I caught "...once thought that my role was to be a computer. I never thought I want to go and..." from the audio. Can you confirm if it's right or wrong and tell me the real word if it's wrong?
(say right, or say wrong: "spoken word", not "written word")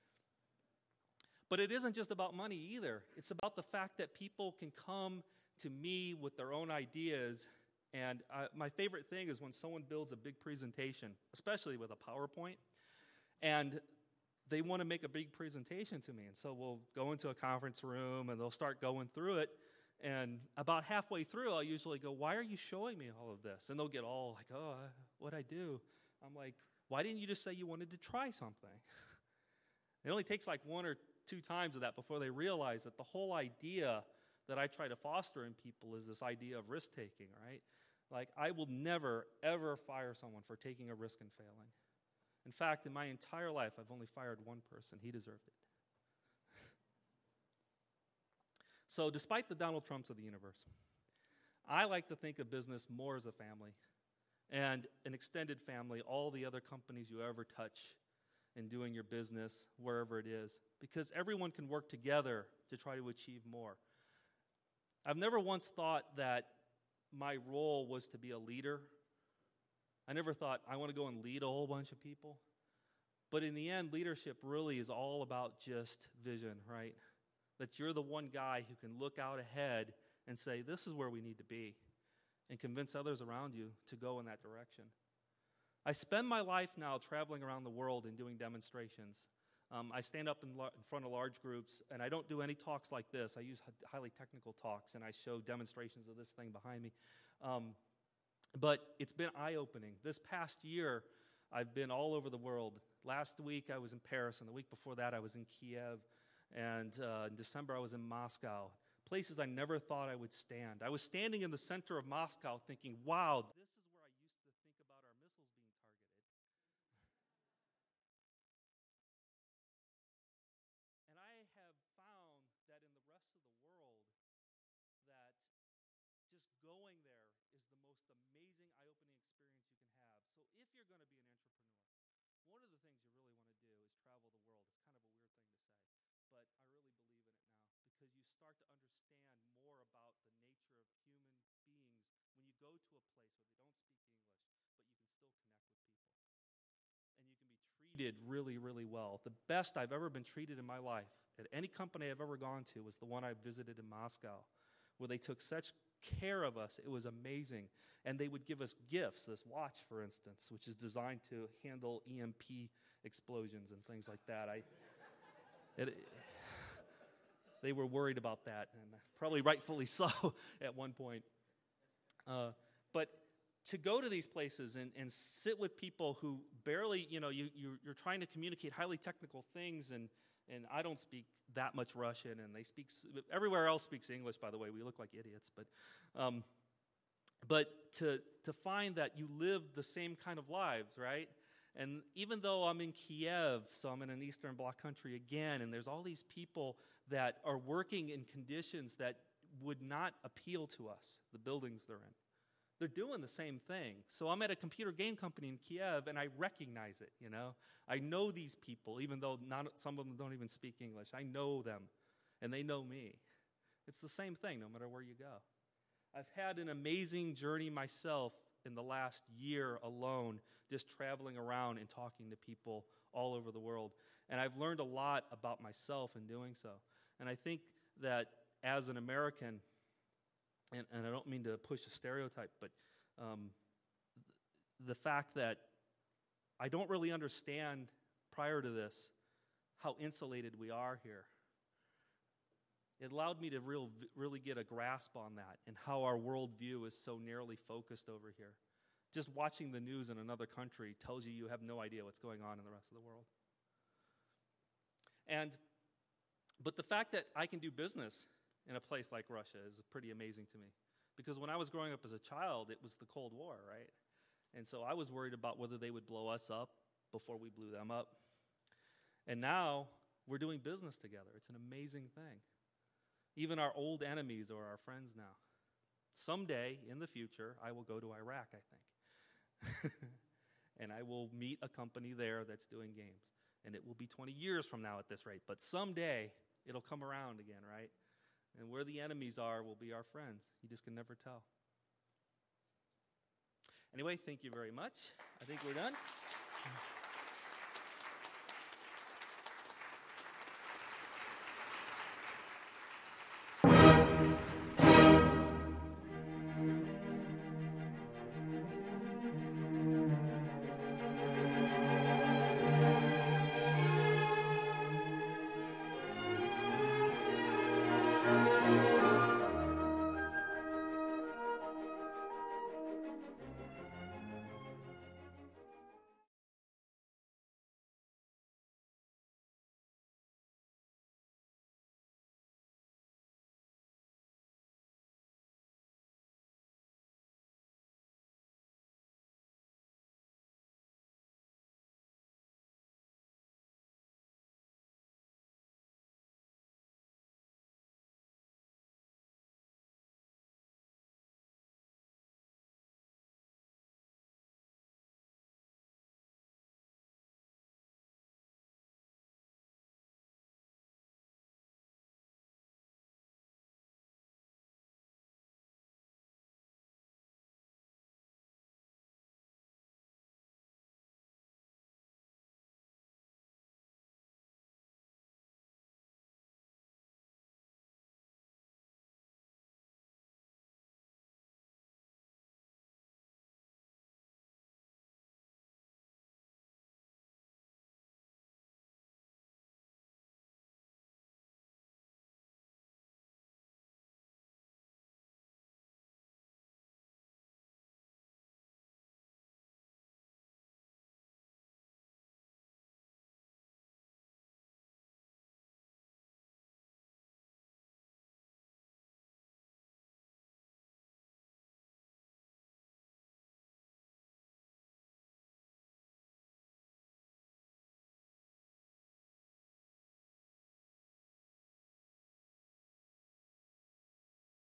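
wrong: "leader", not "computer".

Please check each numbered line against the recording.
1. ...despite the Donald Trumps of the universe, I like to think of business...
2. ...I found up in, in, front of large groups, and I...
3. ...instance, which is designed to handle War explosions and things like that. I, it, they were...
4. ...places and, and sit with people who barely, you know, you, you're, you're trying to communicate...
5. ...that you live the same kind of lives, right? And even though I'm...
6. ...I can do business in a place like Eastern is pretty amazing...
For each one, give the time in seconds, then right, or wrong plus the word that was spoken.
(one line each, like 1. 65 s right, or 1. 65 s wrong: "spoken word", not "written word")
1. 49 s right
2. 89 s wrong: "stand", not "found"
3. 160 s wrong: "EMP", not "War"
4. 174 s right
5. 188 s right
6. 257 s wrong: "Russia", not "Eastern".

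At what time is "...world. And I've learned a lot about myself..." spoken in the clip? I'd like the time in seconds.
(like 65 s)
223 s.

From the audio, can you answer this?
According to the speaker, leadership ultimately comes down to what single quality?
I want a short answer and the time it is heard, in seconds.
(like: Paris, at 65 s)
Vision, at 76 s.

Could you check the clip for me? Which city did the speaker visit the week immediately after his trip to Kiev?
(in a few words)
Paris.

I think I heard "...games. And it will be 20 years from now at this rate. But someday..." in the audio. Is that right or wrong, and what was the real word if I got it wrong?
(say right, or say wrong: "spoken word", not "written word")
right.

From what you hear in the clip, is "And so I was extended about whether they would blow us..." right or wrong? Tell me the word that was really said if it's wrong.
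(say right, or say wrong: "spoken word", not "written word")
wrong: "worried", not "extended".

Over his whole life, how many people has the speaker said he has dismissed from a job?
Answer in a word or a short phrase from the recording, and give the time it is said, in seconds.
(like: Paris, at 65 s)
1, at 44 s.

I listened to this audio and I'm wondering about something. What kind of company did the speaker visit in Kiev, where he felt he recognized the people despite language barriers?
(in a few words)
Computer game company.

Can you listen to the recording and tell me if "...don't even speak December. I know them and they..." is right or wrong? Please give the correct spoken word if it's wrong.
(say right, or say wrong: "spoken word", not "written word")
wrong: "English", not "December".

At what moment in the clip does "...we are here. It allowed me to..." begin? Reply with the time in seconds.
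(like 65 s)
240 s.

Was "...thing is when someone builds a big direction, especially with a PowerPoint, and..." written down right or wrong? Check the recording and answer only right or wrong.
wrong.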